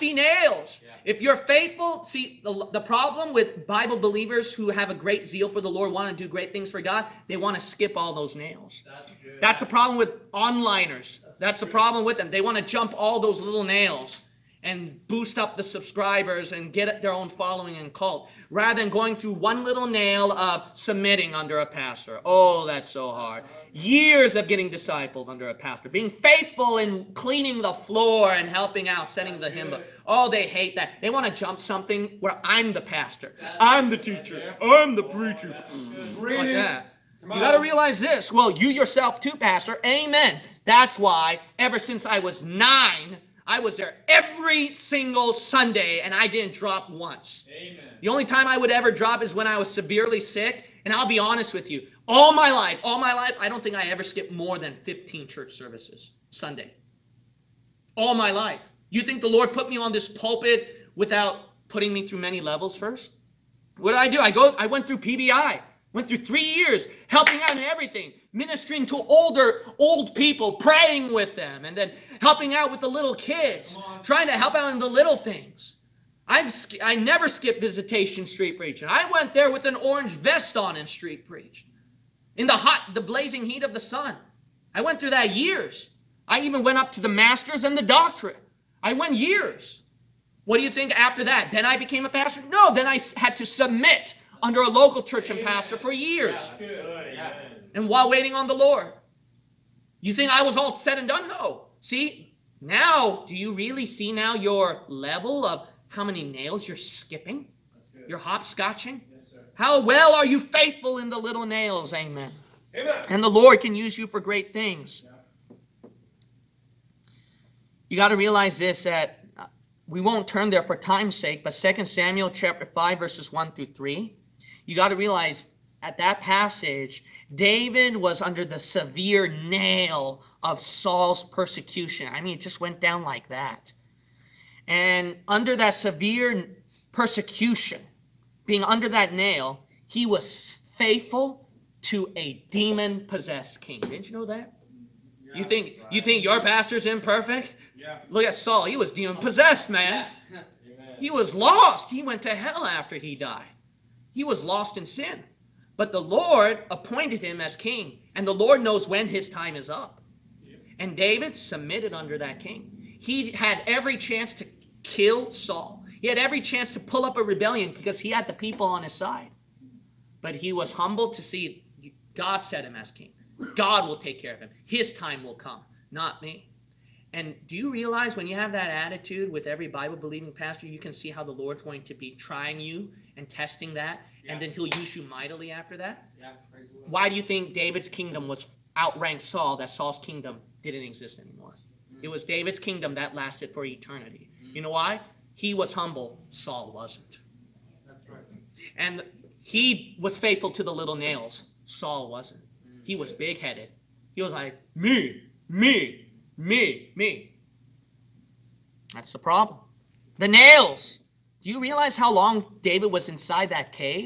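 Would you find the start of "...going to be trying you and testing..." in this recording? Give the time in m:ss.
3:01.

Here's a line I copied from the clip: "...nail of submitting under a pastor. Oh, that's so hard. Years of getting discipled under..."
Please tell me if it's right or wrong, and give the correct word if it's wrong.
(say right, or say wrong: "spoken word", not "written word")
right.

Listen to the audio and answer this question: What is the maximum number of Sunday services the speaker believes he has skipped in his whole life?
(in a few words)
15.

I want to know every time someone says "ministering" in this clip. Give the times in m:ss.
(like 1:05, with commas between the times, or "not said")
1:08.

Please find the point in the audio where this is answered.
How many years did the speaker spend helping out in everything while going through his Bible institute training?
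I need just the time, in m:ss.
1:06.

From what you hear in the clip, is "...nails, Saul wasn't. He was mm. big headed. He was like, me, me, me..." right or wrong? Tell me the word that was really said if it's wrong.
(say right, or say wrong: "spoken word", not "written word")
right.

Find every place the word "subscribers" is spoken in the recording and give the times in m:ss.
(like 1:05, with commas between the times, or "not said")
0:15.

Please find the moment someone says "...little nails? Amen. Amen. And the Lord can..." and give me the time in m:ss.
1:51.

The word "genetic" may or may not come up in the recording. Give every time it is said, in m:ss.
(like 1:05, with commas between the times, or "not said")
not said.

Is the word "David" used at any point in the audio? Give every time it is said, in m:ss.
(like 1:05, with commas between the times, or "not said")
2:07, 2:40, 3:07, 3:12, 3:32.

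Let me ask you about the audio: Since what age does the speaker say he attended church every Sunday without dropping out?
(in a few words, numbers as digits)
9.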